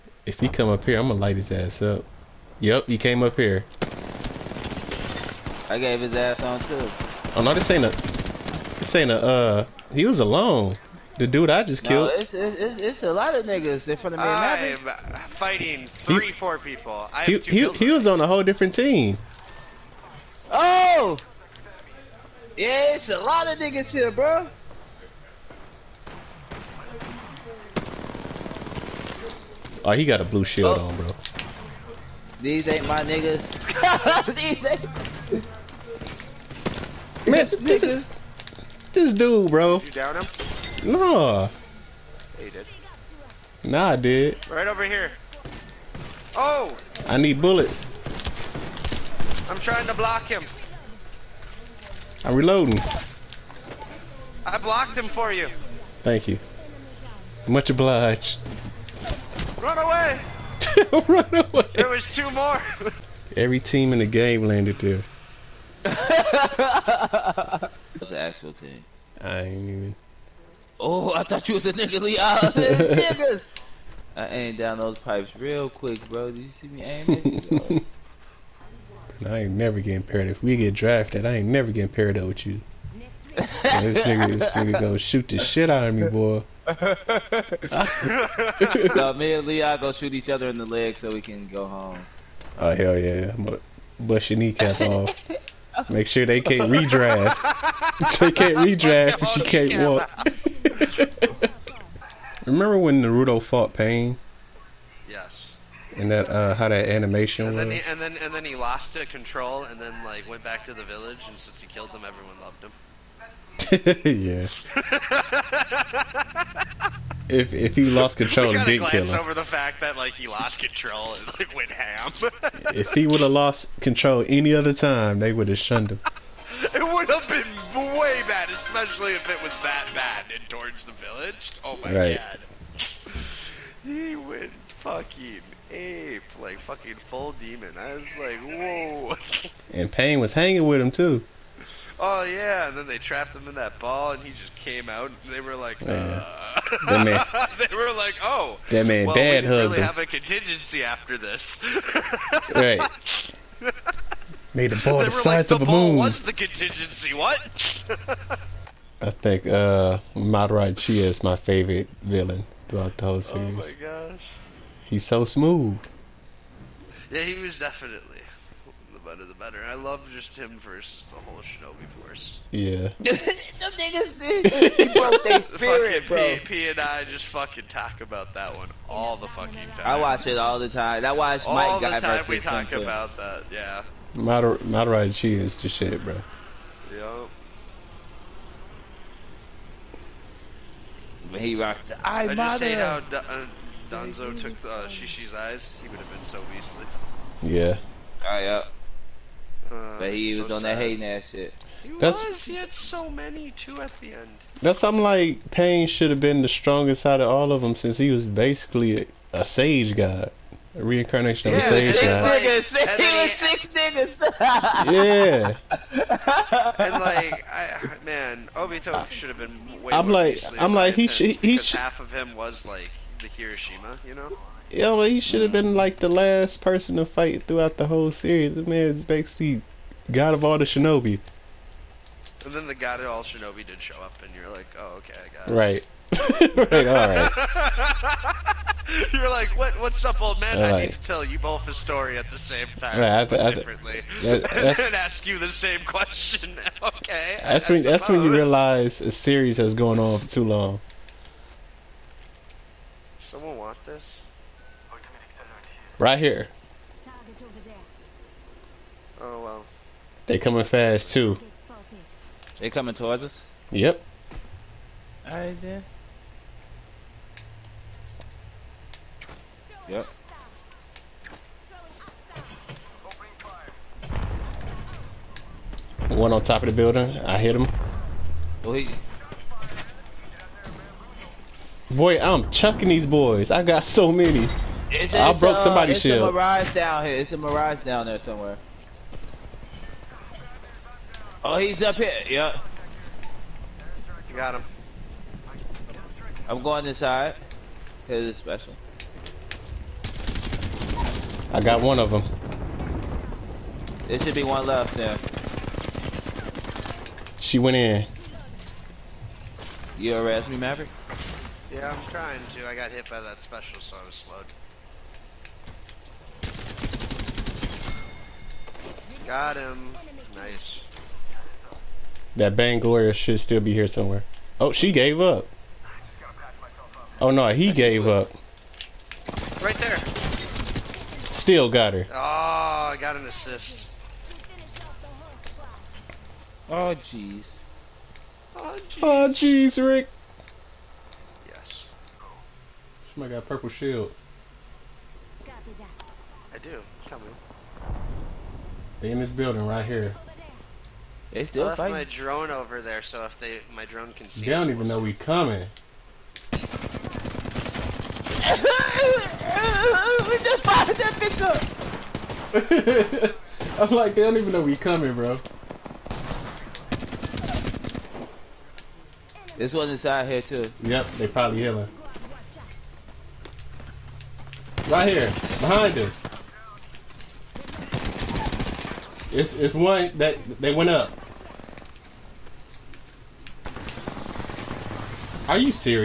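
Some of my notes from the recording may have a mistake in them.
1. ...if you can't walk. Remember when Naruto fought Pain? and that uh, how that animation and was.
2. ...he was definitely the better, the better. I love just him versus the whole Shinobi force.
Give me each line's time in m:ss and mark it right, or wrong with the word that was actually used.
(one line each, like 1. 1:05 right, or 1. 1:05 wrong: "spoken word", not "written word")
1. 1:40 right
2. 2:47 right.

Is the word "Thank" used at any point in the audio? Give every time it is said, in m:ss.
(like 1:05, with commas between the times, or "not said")
0:56.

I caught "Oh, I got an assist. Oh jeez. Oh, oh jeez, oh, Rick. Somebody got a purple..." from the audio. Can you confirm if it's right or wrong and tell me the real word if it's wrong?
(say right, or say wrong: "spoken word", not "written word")
right.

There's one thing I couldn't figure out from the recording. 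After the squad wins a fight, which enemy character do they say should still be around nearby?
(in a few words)
Bangalore.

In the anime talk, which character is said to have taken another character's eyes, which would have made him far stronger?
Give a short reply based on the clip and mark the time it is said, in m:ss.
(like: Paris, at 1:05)
Danzo, at 3:13.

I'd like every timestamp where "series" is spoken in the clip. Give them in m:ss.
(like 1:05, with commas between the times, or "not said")
2:43, 3:48, 4:09.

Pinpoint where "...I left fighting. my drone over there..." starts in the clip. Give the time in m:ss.
5:51.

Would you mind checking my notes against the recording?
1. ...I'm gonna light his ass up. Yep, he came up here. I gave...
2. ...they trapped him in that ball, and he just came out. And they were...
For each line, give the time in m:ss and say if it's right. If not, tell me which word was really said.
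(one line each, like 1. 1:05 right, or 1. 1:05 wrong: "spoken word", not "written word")
1. 0:00 right
2. 2:22 right.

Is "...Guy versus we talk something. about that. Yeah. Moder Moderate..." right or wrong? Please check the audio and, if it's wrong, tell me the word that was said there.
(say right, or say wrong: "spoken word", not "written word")
right.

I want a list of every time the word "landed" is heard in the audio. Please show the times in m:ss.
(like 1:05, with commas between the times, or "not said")
1:04.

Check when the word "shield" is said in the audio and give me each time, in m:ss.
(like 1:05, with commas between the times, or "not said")
0:30, 4:46, 5:43.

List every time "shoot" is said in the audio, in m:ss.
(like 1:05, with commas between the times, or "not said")
1:24, 1:29.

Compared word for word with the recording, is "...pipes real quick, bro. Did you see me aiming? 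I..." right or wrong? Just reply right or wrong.
right.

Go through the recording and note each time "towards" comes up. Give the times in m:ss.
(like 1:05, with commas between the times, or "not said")
2:10, 4:22.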